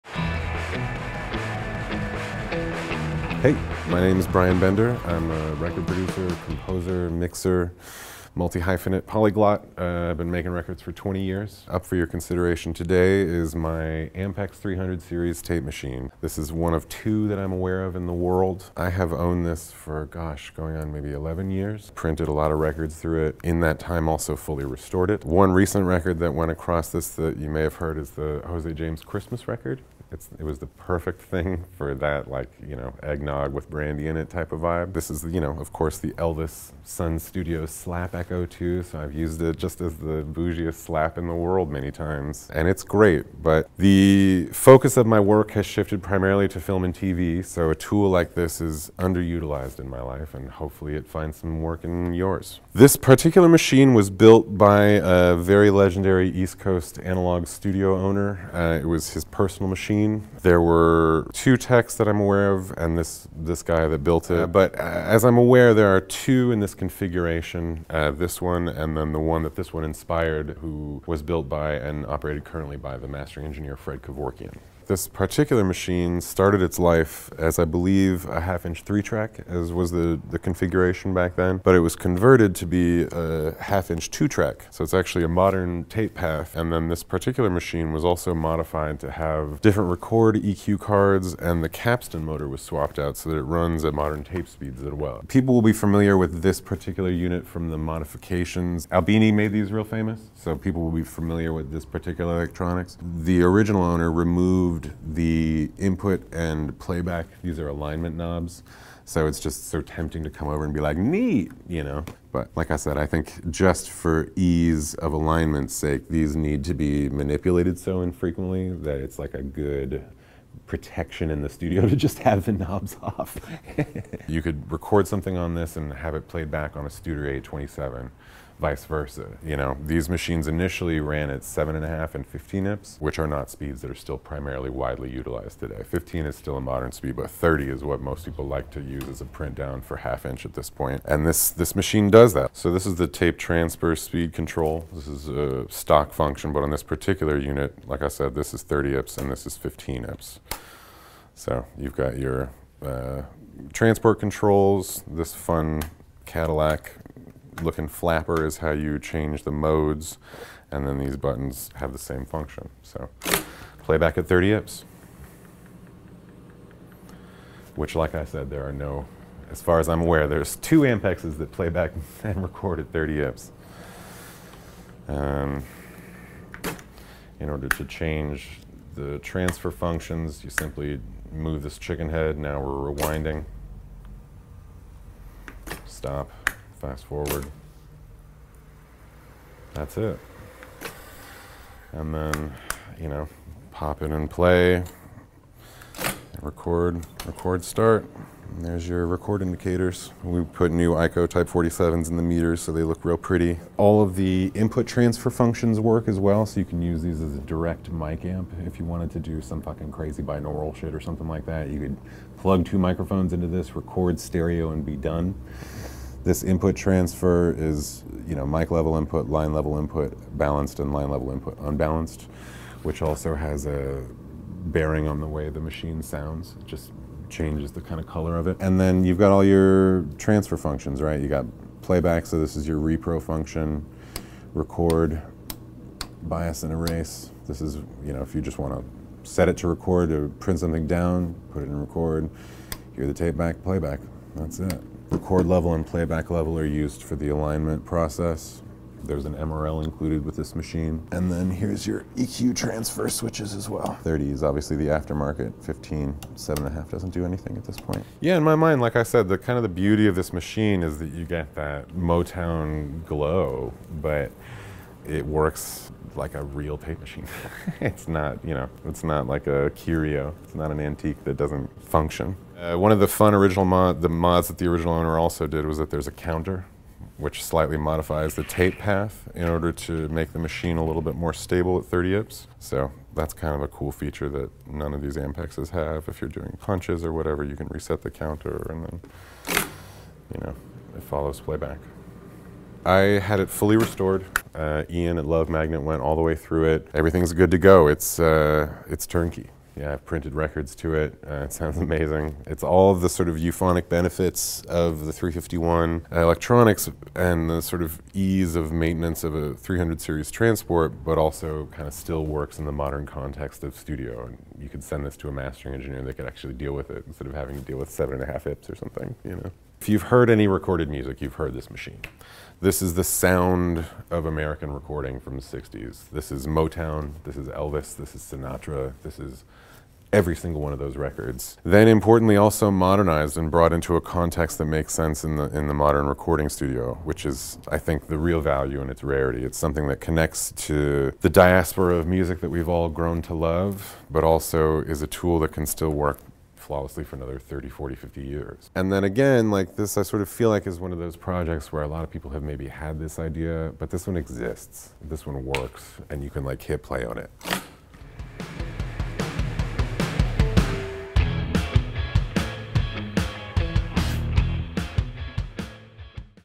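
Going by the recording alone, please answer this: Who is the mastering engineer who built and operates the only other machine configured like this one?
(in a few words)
Fred Kevorkian.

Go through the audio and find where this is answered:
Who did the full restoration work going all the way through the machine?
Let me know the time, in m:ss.
4:54.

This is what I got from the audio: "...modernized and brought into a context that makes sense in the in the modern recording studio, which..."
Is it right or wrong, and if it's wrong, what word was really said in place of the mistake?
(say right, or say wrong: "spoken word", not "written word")
right.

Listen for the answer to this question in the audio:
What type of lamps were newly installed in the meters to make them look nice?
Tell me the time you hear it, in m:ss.
3:20.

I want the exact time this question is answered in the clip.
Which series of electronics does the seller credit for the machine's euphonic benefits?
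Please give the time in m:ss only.
5:05.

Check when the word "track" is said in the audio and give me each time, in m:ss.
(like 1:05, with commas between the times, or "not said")
1:19, 1:24.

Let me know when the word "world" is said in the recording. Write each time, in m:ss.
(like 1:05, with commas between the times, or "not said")
0:18, 0:41.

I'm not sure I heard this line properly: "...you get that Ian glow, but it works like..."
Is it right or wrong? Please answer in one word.
wrong.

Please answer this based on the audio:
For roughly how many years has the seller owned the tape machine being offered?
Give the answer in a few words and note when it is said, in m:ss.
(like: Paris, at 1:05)
11 years, at 0:21.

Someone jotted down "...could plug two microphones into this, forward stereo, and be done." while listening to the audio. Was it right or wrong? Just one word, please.
wrong.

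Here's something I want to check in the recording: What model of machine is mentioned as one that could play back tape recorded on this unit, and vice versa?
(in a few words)
Studer A27.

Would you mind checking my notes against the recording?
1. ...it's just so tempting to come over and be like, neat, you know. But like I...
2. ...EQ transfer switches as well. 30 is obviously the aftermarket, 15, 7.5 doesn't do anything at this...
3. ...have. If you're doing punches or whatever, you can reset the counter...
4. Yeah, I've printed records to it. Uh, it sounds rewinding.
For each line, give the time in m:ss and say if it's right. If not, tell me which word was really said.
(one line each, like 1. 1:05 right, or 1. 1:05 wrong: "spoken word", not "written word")
1. 1:49 right
2. 4:12 right
3. 4:45 right
4. 4:59 wrong: "amazing", not "rewinding".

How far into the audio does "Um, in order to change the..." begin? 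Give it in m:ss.
2:55.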